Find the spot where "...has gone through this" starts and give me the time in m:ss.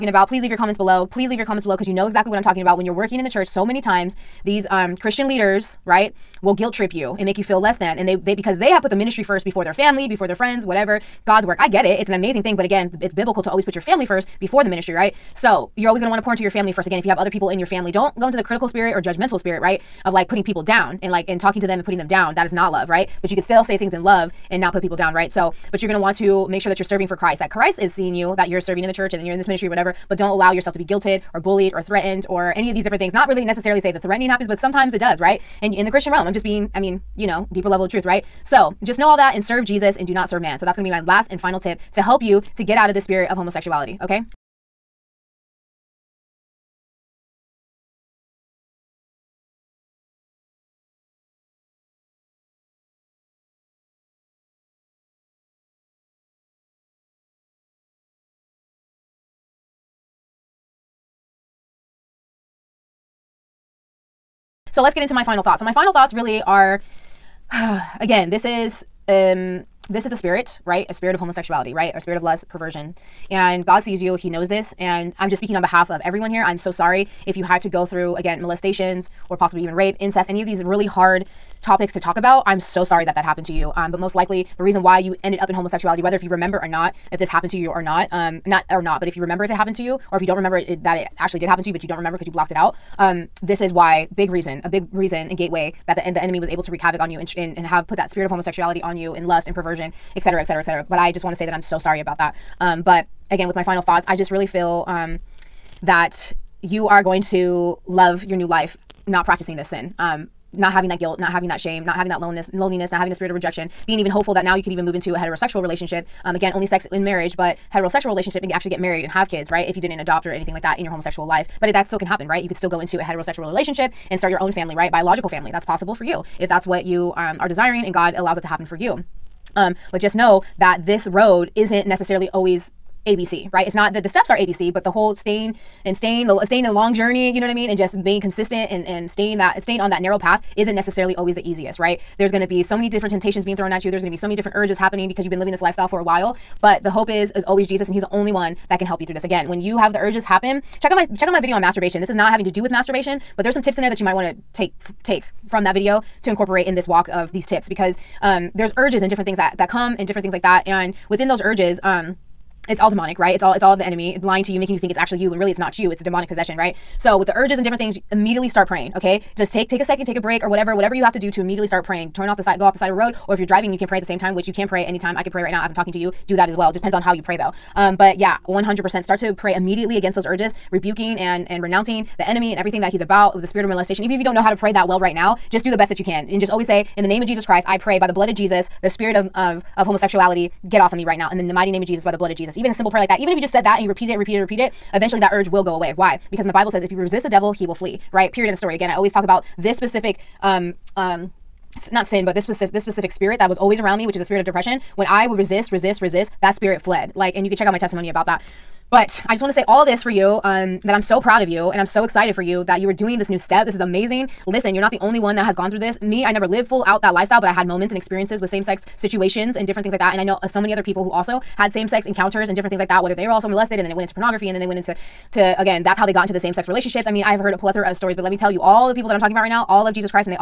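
3:35.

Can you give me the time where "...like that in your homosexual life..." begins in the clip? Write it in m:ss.
2:00.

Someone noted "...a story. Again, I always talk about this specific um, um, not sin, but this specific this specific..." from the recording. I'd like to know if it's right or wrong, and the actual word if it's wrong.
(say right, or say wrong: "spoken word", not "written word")
right.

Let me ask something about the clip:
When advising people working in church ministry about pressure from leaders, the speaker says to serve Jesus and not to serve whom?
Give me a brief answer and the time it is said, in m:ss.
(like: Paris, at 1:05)
man, at 0:40.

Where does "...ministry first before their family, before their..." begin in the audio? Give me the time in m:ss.
0:08.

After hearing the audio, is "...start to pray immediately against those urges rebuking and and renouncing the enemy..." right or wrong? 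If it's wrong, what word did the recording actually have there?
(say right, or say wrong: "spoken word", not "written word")
right.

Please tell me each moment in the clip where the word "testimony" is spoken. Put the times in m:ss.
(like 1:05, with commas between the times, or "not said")
3:27.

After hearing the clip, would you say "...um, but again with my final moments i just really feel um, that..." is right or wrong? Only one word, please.
wrong.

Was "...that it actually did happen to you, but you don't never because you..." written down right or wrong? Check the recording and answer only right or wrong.
wrong.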